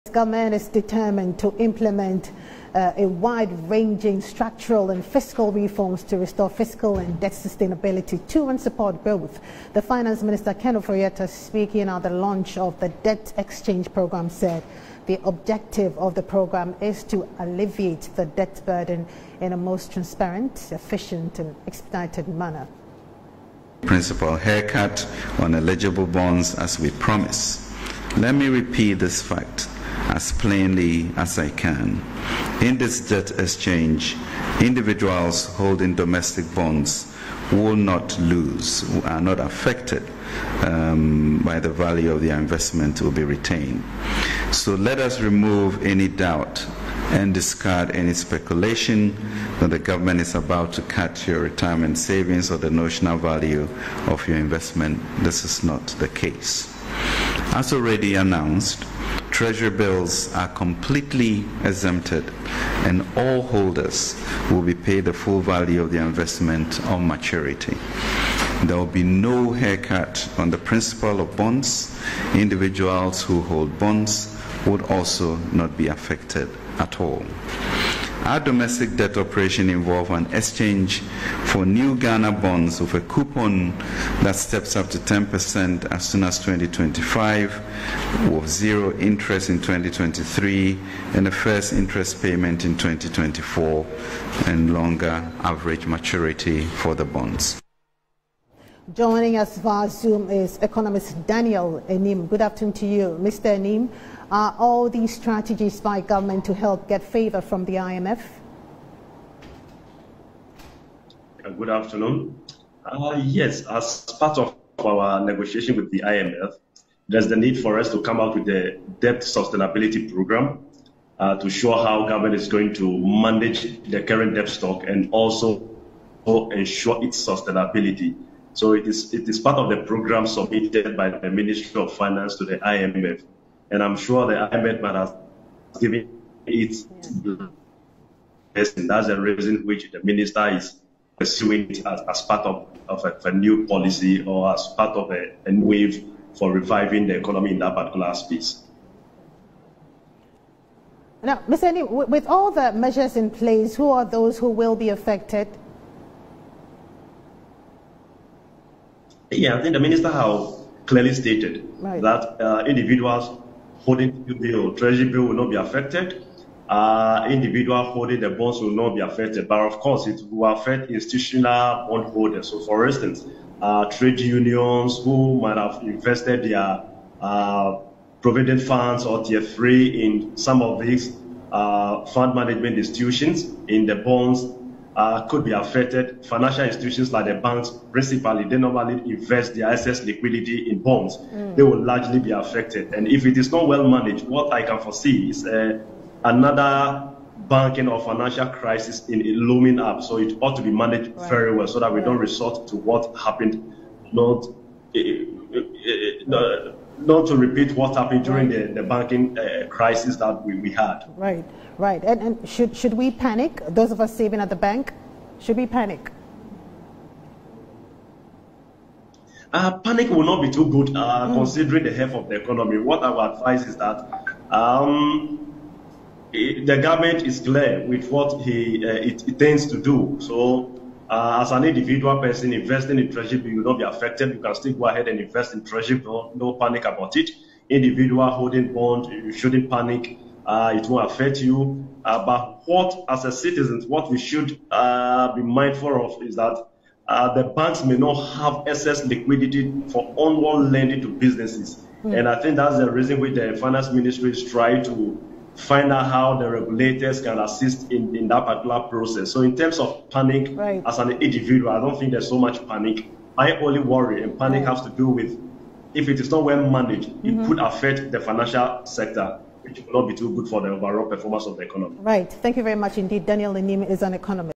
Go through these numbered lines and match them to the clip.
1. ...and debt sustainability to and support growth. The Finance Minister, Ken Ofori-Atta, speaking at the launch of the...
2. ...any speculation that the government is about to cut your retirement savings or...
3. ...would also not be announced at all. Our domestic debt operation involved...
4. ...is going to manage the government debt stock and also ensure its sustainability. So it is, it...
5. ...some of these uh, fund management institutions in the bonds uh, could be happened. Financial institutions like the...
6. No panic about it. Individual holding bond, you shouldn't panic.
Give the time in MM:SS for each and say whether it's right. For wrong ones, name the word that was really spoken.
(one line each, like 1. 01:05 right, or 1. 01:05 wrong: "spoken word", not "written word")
1. 00:06 right
2. 00:47 right
3. 01:14 wrong: "affected", not "announced"
4. 02:02 wrong: "current", not "government"
5. 03:00 wrong: "affected", not "happened"
6. 03:56 right.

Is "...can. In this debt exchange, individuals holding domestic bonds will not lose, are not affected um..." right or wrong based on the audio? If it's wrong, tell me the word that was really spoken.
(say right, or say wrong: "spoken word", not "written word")
right.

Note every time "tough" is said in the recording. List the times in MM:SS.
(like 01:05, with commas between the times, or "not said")
not said.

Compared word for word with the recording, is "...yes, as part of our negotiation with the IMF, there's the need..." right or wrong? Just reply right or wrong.
right.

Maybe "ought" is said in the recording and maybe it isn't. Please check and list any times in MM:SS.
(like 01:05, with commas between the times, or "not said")
03:20.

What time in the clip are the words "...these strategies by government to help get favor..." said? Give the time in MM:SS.
01:44.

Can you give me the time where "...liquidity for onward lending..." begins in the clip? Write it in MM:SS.
04:09.